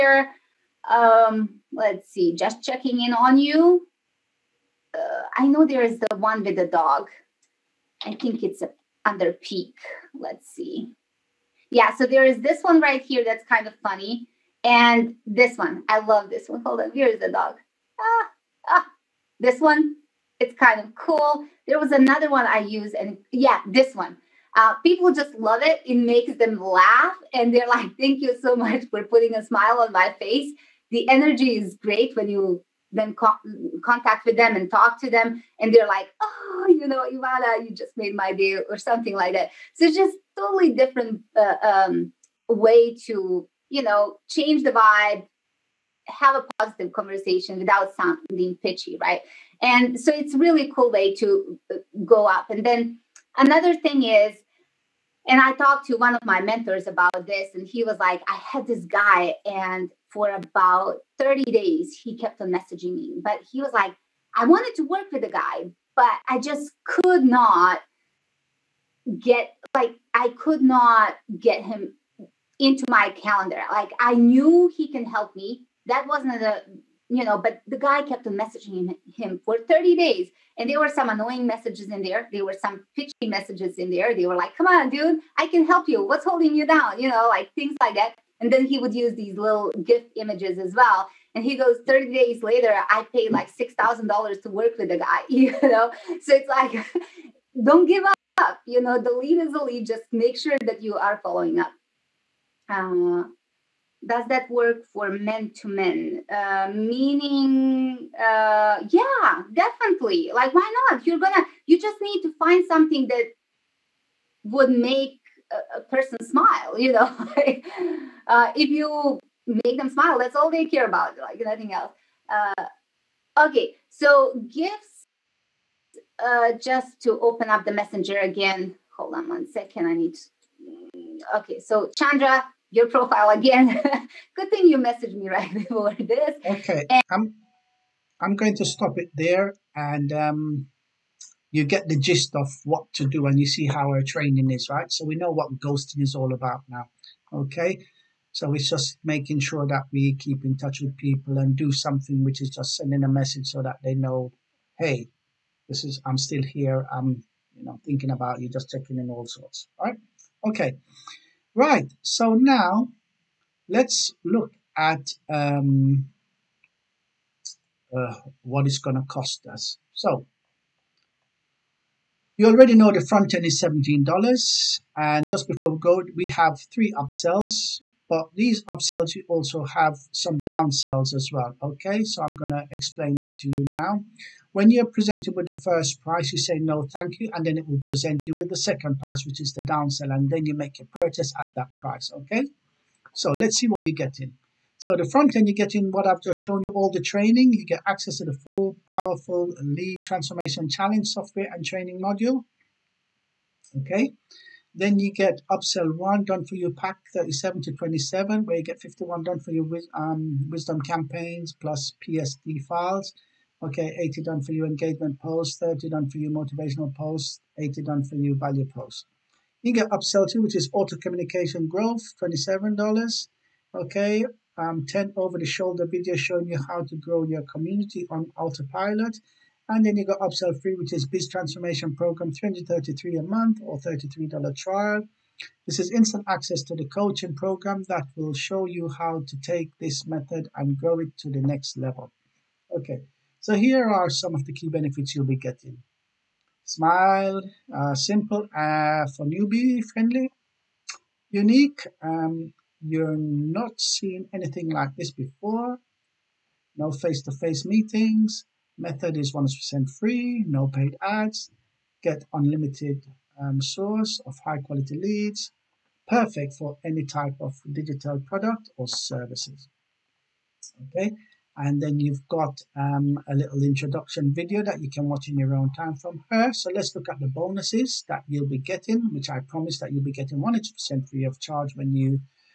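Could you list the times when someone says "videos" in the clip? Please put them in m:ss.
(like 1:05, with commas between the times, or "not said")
3:45, 4:34.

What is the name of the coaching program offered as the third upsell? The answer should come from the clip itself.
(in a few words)
Biz Transformation Program.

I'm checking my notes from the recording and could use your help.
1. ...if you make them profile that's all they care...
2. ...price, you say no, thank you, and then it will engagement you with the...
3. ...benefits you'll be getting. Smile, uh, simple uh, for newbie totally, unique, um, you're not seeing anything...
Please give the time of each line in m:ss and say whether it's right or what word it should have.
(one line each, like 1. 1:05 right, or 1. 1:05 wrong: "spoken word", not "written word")
1. 1:58 wrong: "smile", not "profile"
2. 3:06 wrong: "present", not "engagement"
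3. 4:04 wrong: "friendly", not "totally".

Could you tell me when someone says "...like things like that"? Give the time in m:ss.
1:27.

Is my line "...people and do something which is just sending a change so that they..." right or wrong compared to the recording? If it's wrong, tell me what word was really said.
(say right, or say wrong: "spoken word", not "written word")
wrong: "message", not "change".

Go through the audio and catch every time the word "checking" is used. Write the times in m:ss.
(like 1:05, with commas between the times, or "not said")
0:02, 2:38.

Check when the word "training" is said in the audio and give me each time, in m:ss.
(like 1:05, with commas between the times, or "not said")
2:24, 3:16, 3:21.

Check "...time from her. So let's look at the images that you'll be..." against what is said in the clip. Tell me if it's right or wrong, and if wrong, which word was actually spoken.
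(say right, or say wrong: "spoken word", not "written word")
wrong: "bonuses", not "images".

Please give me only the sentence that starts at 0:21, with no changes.
There was another one I use, and yeah, this one.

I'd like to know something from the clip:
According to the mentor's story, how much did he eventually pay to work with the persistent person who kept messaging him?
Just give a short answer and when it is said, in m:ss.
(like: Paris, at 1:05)
$6,000, at 1:33.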